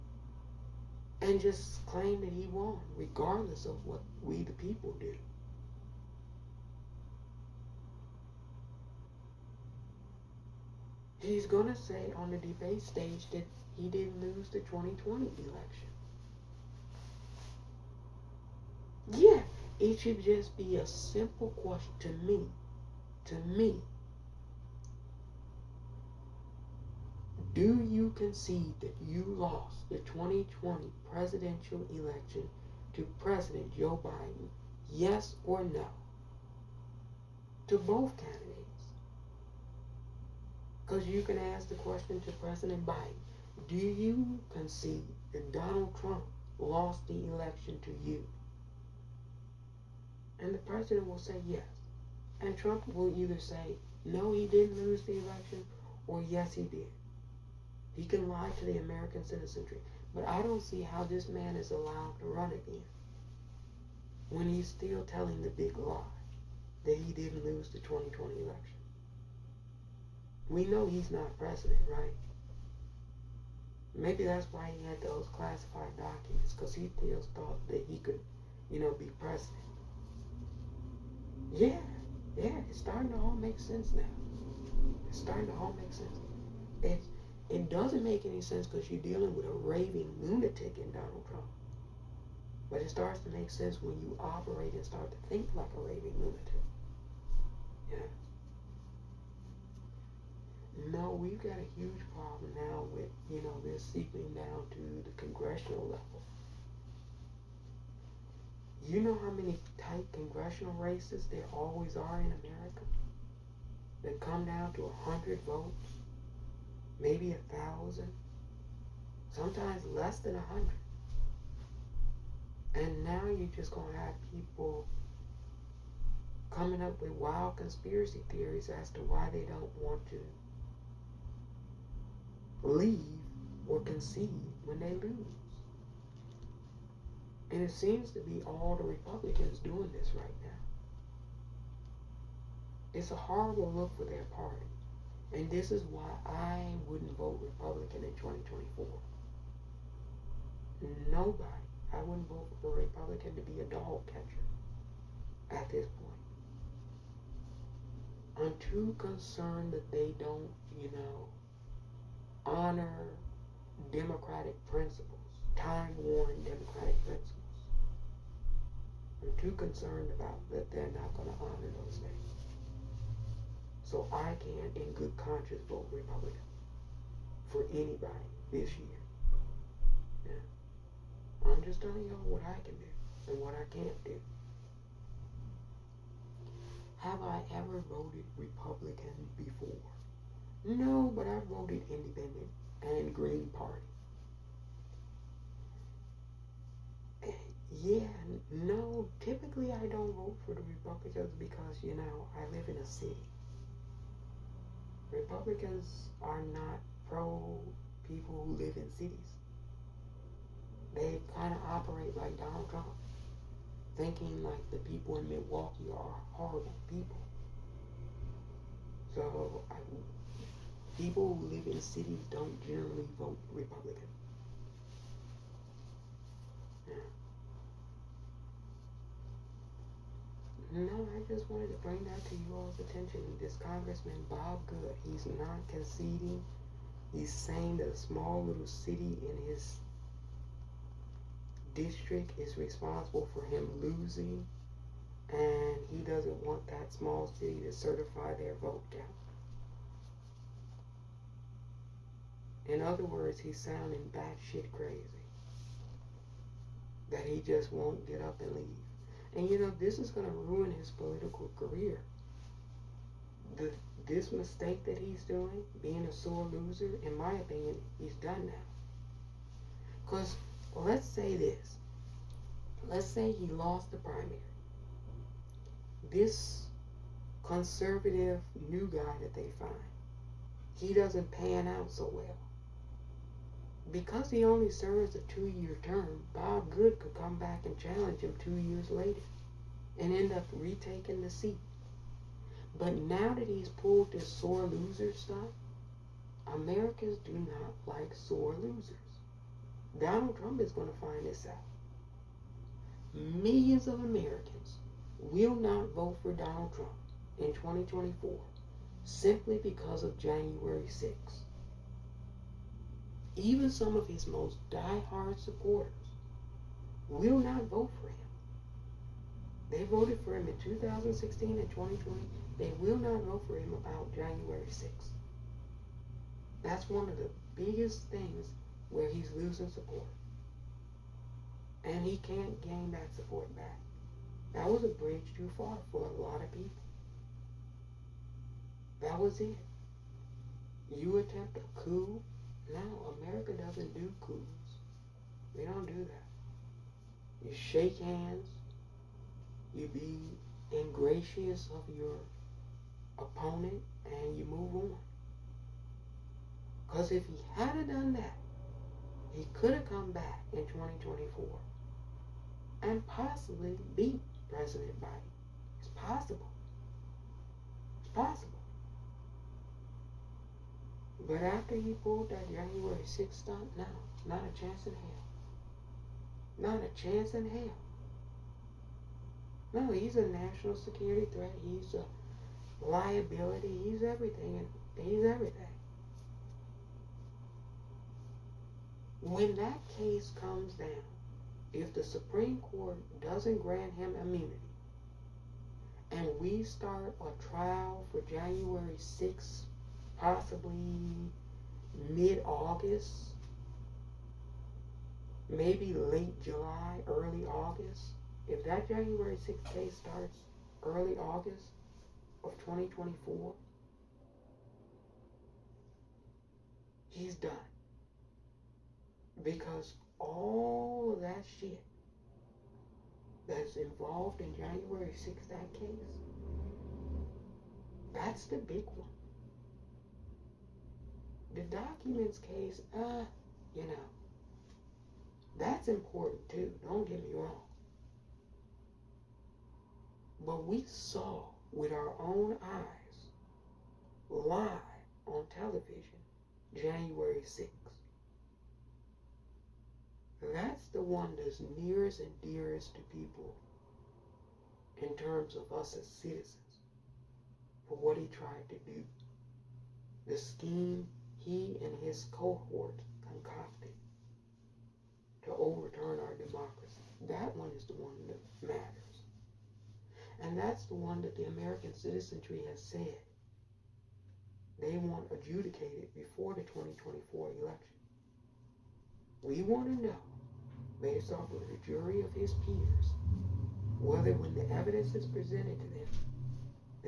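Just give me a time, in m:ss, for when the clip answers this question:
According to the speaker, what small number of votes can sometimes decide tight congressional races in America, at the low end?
1:54.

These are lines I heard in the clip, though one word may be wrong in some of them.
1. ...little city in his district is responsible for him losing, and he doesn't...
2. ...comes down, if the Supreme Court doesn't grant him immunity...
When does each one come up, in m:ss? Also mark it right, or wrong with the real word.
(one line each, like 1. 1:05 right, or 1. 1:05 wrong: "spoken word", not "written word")
1. 3:58 right
2. 6:30 right.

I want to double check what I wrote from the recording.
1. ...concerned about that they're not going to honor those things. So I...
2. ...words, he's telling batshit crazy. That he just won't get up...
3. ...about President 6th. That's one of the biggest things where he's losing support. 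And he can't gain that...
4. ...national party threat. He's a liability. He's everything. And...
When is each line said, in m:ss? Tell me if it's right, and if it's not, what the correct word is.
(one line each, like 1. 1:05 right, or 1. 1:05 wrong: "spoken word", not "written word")
1. 2:49 right
2. 4:13 wrong: "sounding", not "telling"
3. 5:23 wrong: "January", not "President"
4. 6:20 wrong: "security", not "party".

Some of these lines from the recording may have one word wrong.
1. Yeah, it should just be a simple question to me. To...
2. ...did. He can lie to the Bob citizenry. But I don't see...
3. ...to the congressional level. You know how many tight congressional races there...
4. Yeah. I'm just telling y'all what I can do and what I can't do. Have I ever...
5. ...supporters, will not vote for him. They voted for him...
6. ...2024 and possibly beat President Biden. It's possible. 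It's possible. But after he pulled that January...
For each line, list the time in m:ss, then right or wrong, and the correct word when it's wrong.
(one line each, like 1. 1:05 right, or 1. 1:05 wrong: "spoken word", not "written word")
1. 0:19 right
2. 0:56 wrong: "American", not "Bob"
3. 1:44 right
4. 3:00 right
5. 5:15 right
6. 6:00 right.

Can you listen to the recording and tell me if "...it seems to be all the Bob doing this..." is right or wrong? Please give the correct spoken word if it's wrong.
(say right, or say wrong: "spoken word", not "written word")
wrong: "Republicans", not "Bob".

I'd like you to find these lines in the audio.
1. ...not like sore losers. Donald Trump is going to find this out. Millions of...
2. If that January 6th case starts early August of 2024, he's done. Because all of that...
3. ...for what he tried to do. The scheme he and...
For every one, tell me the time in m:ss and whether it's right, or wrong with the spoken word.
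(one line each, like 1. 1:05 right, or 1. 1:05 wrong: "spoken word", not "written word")
1. 4:57 right
2. 6:48 right
3. 7:37 right.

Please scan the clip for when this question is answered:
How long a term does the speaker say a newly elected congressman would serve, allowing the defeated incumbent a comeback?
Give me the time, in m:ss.
4:45.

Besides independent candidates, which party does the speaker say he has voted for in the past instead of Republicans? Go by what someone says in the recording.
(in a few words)
Green Party.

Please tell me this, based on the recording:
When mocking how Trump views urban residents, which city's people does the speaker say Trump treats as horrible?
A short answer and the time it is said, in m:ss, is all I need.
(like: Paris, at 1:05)
Milwaukee, at 3:35.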